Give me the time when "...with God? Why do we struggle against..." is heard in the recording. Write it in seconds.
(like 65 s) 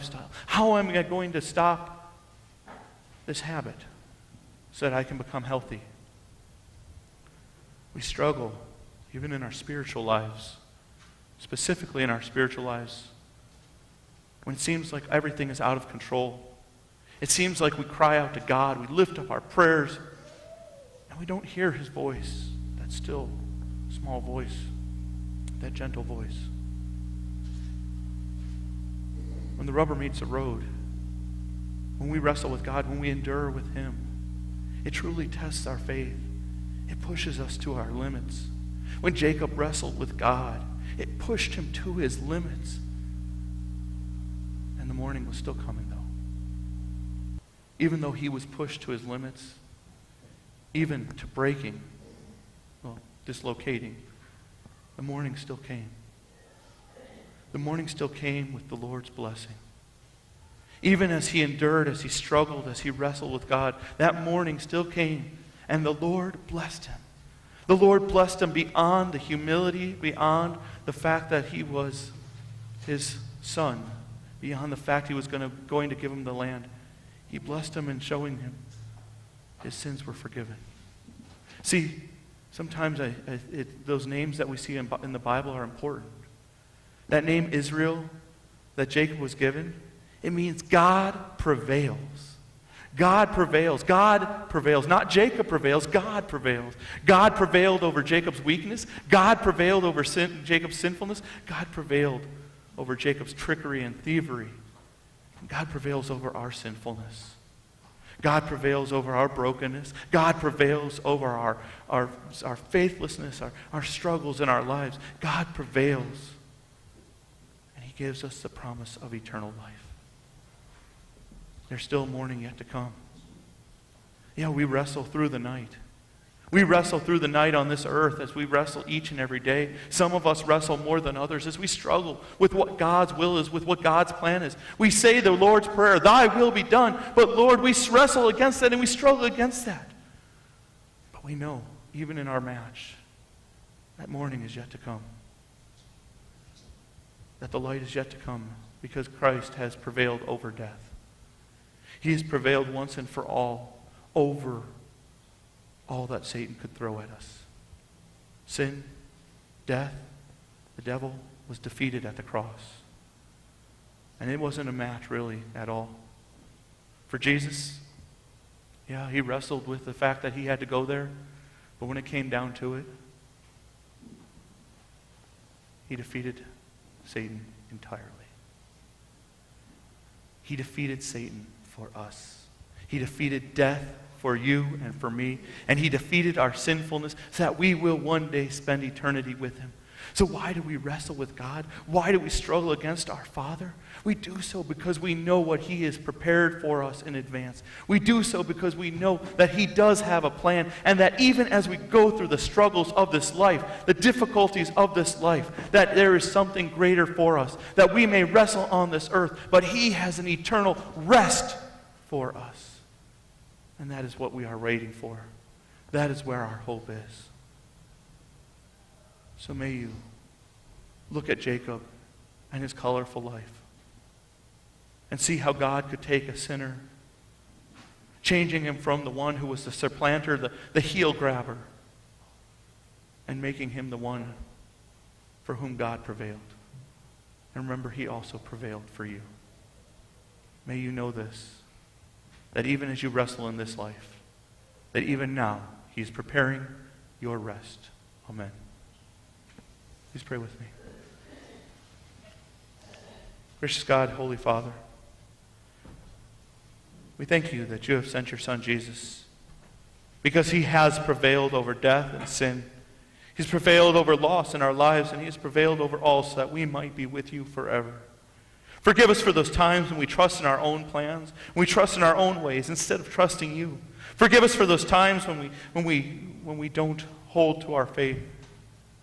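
191 s.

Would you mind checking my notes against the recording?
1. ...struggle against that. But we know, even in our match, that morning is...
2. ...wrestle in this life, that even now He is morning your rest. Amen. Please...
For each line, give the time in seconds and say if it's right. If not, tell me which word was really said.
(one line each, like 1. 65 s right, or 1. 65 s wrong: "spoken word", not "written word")
1. 138 s right
2. 243 s wrong: "preparing", not "morning".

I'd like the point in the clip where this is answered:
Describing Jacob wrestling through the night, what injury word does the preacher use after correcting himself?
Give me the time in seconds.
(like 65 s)
53 s.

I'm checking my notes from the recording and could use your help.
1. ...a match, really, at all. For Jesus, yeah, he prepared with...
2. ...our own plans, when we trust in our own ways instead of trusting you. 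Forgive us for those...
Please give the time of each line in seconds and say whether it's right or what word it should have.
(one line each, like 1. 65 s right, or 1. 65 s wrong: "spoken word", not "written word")
1. 164 s wrong: "wrestled", not "prepared"
2. 270 s right.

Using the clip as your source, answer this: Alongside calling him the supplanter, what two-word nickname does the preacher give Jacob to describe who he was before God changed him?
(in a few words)
heel grabber.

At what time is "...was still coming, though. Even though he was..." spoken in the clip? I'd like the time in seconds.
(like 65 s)
45 s.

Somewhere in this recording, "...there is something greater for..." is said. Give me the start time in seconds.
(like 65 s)
205 s.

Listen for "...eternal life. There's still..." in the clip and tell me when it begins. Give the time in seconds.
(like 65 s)
119 s.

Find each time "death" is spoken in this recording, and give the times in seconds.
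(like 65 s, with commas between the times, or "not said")
150 s, 159 s, 183 s, 261 s.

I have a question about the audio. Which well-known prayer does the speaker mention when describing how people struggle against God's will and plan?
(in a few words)
Lord's Prayer.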